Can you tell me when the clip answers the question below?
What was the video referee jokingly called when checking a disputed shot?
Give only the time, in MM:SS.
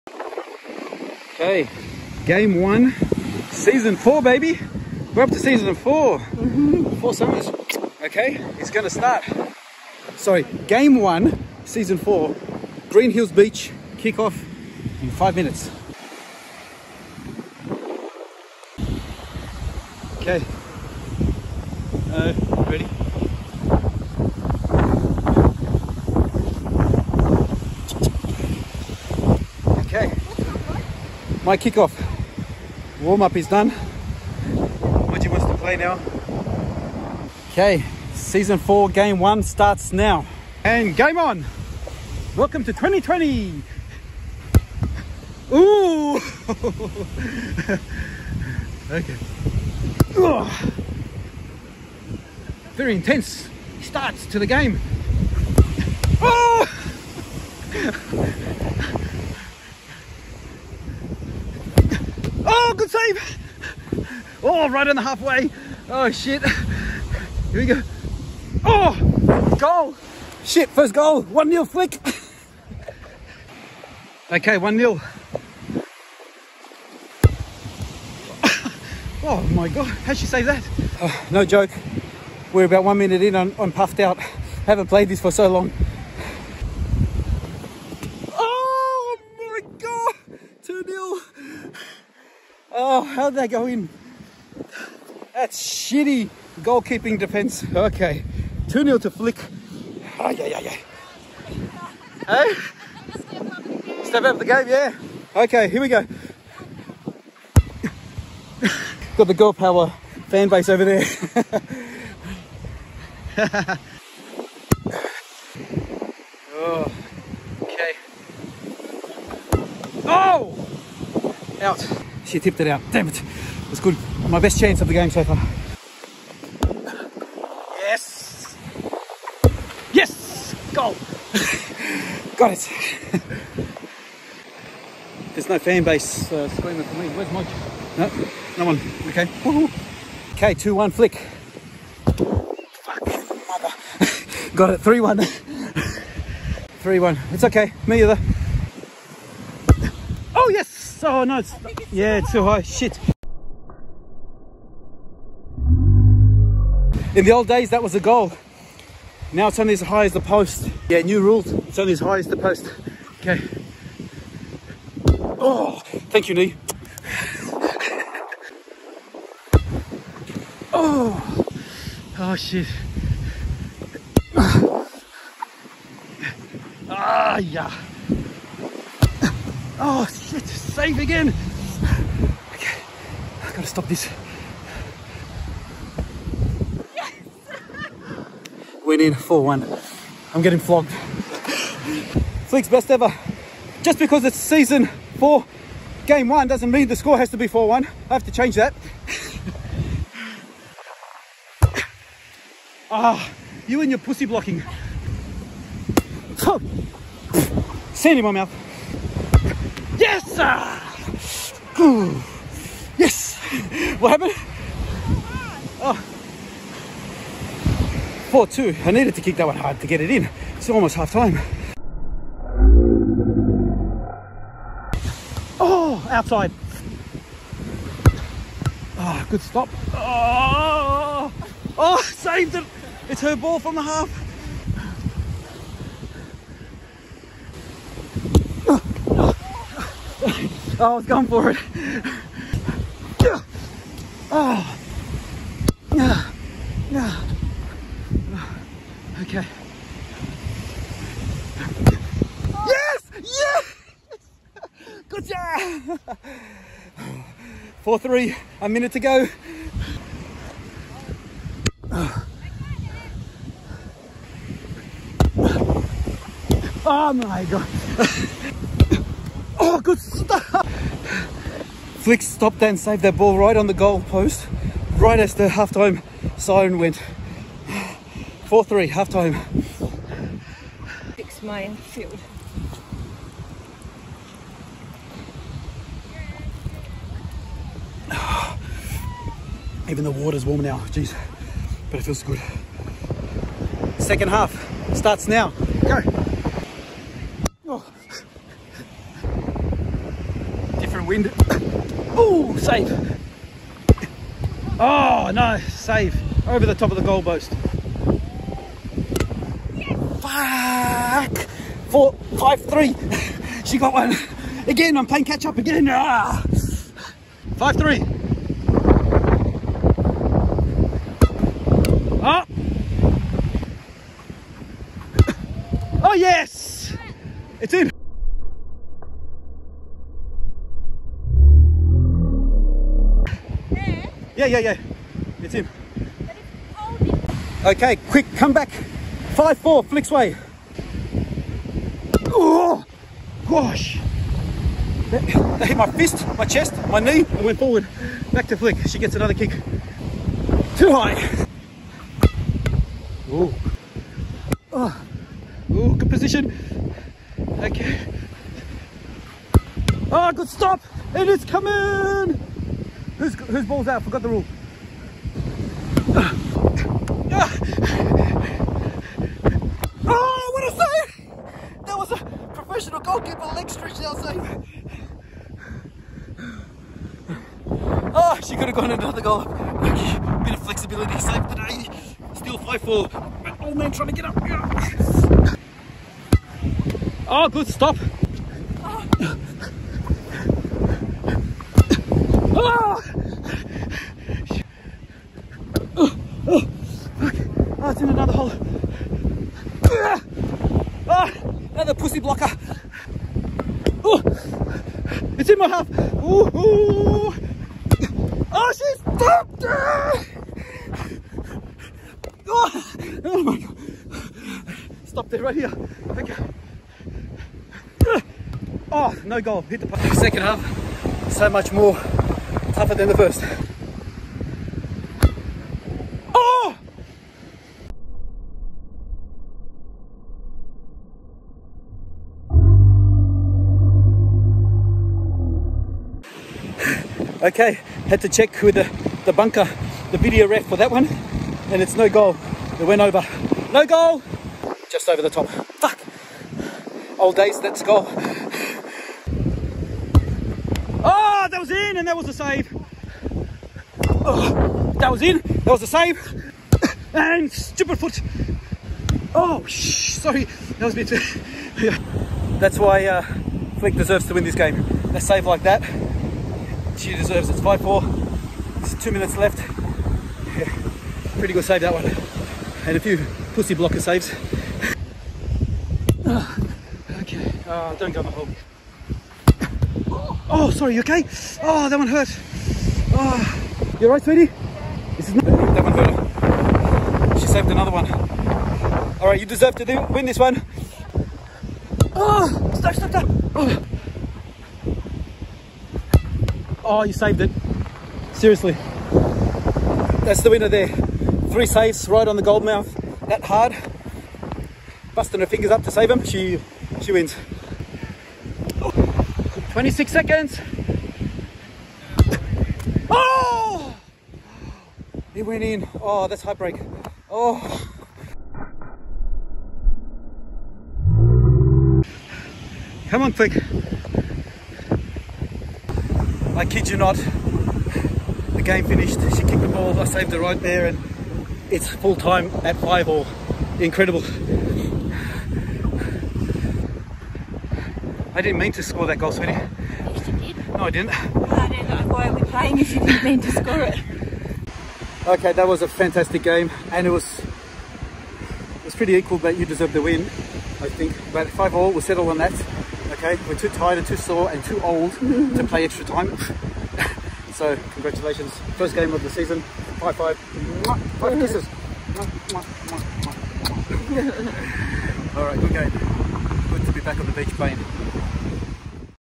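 07:19.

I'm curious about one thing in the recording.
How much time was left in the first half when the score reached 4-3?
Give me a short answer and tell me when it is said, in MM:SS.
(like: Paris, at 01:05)
A minute, at 04:18.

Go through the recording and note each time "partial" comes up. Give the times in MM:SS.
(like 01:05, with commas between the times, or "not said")
not said.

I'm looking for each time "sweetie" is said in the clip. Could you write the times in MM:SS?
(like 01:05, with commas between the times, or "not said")
08:04, 08:59.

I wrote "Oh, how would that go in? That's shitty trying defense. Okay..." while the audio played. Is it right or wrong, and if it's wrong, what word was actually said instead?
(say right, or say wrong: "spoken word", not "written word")
wrong: "goalkeeping", not "trying".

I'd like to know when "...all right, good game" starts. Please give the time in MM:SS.
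09:25.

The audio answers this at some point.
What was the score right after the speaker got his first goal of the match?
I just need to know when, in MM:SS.
02:20.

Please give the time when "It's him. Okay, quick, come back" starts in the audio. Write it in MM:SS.
05:35.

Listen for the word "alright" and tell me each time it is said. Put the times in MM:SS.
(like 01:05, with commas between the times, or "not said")
08:04, 08:09.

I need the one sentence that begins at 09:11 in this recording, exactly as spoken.
But five all, we'll settle on that.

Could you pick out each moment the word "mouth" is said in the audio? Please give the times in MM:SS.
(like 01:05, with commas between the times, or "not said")
03:28, 08:22.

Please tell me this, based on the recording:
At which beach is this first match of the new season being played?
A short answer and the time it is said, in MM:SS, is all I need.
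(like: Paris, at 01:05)
Greenhills Beach, at 00:12.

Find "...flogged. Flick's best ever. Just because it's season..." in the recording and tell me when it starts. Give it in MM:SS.
03:10.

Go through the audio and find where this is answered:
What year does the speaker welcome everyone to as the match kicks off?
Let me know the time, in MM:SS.
00:42.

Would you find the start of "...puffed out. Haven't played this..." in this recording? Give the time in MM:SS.
01:23.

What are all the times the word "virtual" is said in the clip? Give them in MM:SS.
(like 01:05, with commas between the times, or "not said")
not said.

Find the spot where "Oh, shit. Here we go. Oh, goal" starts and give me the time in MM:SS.
01:05.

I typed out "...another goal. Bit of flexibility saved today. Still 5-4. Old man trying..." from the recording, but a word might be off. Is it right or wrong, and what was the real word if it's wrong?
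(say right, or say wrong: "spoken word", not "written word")
right.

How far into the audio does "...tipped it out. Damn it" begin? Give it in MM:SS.
02:02.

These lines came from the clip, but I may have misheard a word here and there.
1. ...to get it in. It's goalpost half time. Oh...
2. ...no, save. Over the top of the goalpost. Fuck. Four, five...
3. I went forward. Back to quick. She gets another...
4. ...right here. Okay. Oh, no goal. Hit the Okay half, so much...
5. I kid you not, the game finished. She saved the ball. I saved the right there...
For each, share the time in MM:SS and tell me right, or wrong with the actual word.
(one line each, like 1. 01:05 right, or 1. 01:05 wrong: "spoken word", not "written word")
1. 03:39 wrong: "almost", not "goalpost"
2. 05:05 right
3. 05:47 wrong: "flick", not "quick"
4. 06:55 wrong: "Second", not "Okay"
5. 08:46 wrong: "kicked", not "saved".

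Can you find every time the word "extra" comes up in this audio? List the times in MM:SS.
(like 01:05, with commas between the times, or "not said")
09:15.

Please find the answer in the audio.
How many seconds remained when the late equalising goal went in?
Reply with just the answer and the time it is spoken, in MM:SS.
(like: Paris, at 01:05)
26, at 08:29.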